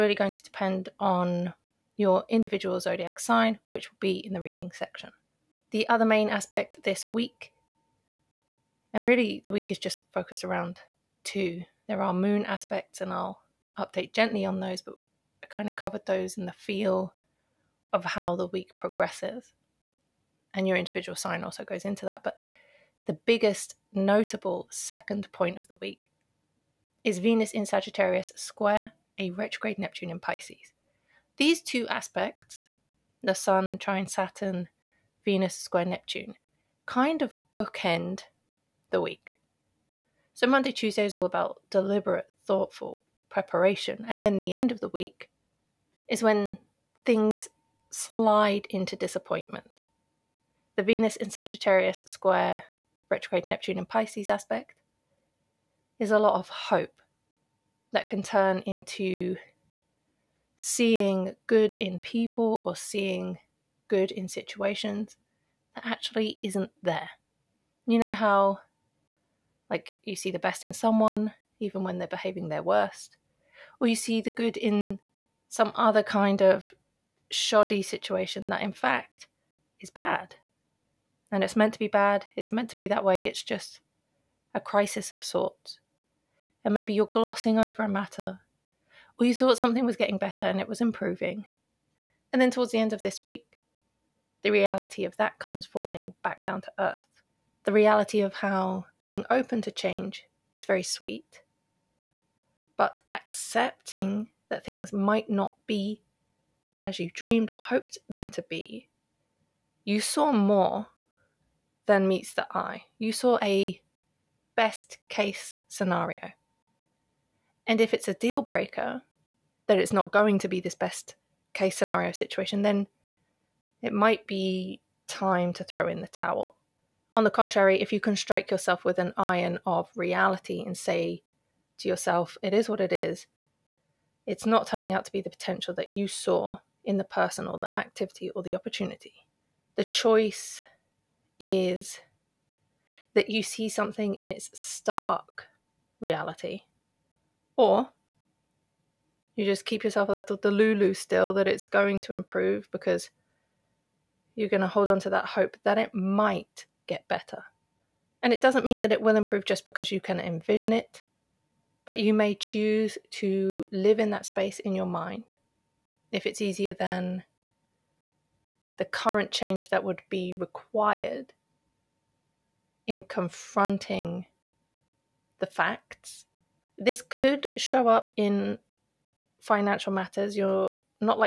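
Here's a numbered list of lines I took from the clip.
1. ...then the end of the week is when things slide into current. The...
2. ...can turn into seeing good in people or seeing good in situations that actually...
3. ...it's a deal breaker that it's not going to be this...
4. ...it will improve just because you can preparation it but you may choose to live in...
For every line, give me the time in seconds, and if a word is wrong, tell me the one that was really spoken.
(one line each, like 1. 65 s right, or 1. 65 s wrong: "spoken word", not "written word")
1. 44 s wrong: "disappointment", not "current"
2. 58 s right
3. 117 s right
4. 158 s wrong: "envision", not "preparation".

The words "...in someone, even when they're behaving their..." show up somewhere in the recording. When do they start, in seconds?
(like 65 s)
70 s.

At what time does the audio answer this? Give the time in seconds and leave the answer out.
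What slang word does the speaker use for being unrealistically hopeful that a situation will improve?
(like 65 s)
150 s.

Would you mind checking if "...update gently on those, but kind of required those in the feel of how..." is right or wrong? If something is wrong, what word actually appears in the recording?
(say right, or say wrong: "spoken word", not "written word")
wrong: "covered", not "required".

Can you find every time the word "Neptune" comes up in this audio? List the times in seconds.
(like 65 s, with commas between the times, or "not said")
29 s, 35 s, 53 s.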